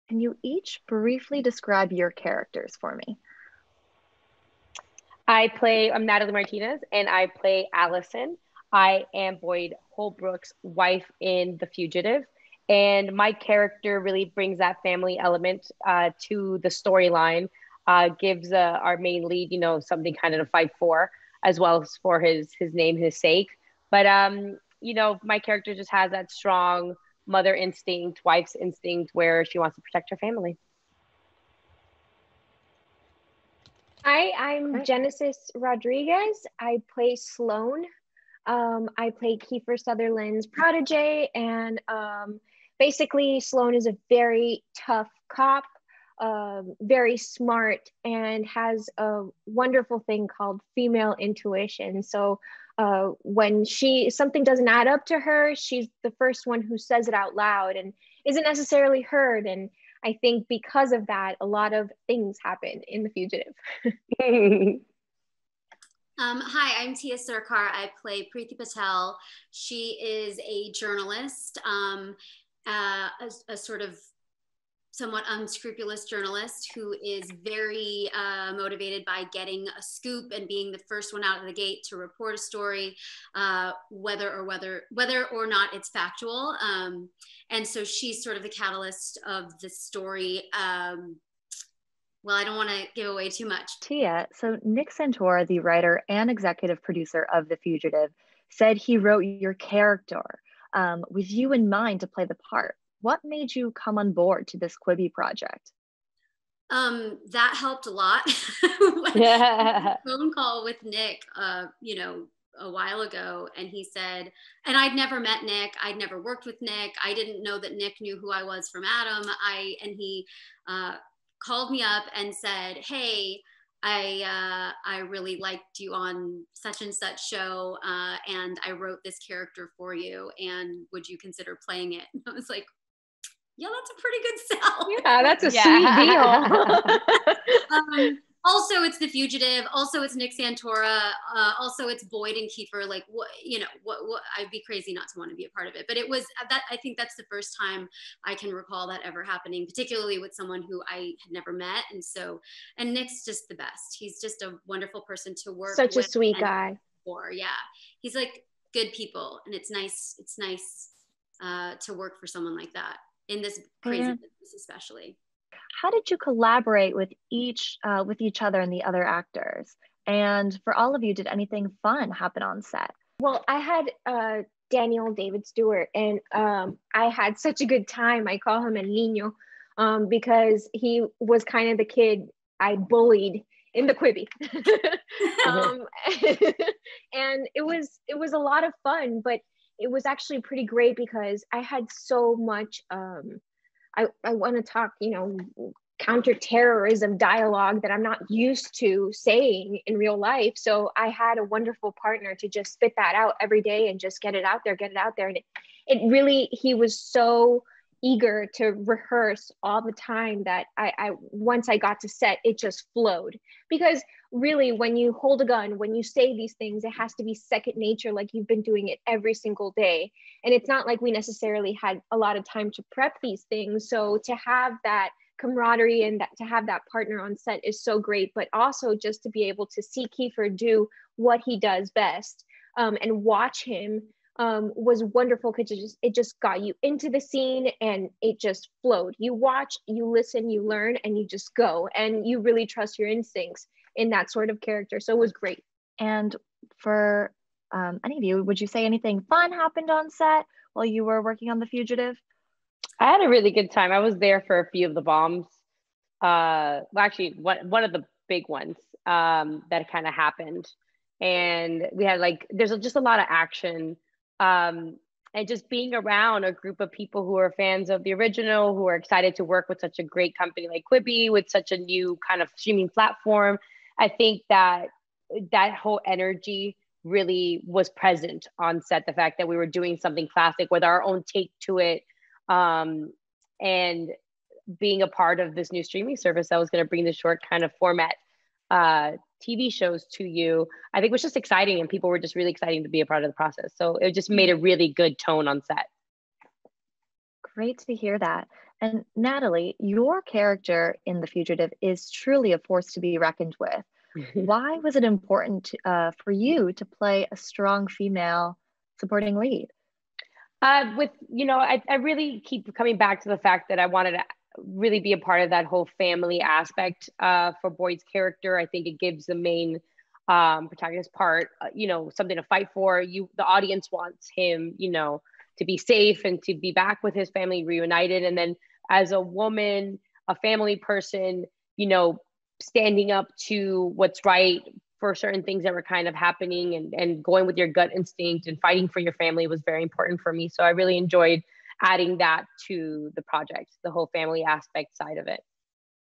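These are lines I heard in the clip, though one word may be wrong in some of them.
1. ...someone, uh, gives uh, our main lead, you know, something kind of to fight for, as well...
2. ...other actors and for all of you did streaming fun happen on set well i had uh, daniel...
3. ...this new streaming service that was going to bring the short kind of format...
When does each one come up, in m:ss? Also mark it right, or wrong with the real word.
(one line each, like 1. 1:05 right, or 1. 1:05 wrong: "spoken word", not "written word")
1. 0:16 wrong: "storyline", not "someone"
2. 2:48 wrong: "anything", not "streaming"
3. 4:45 right.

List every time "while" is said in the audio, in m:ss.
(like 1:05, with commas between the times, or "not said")
1:52, 4:10.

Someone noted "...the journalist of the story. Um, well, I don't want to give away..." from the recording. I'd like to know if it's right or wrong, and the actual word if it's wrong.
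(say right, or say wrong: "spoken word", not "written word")
wrong: "catalyst", not "journalist".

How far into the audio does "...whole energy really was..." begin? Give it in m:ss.
4:35.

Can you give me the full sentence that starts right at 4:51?
And people were just really exciting to be a part of the process.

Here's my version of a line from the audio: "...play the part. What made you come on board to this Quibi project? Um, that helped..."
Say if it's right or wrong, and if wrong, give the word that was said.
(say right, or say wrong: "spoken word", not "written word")
right.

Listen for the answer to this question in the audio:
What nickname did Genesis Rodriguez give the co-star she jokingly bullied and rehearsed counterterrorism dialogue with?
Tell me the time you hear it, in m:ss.
2:58.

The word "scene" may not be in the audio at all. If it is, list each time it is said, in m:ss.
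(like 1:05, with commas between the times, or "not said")
3:57.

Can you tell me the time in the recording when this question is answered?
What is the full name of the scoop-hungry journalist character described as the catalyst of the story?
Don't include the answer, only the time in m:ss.
1:08.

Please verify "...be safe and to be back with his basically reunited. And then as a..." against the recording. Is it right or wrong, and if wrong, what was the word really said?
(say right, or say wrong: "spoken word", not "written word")
wrong: "family", not "basically".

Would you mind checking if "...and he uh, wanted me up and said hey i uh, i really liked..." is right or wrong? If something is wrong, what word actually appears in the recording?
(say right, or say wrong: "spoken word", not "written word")
wrong: "called", not "wanted".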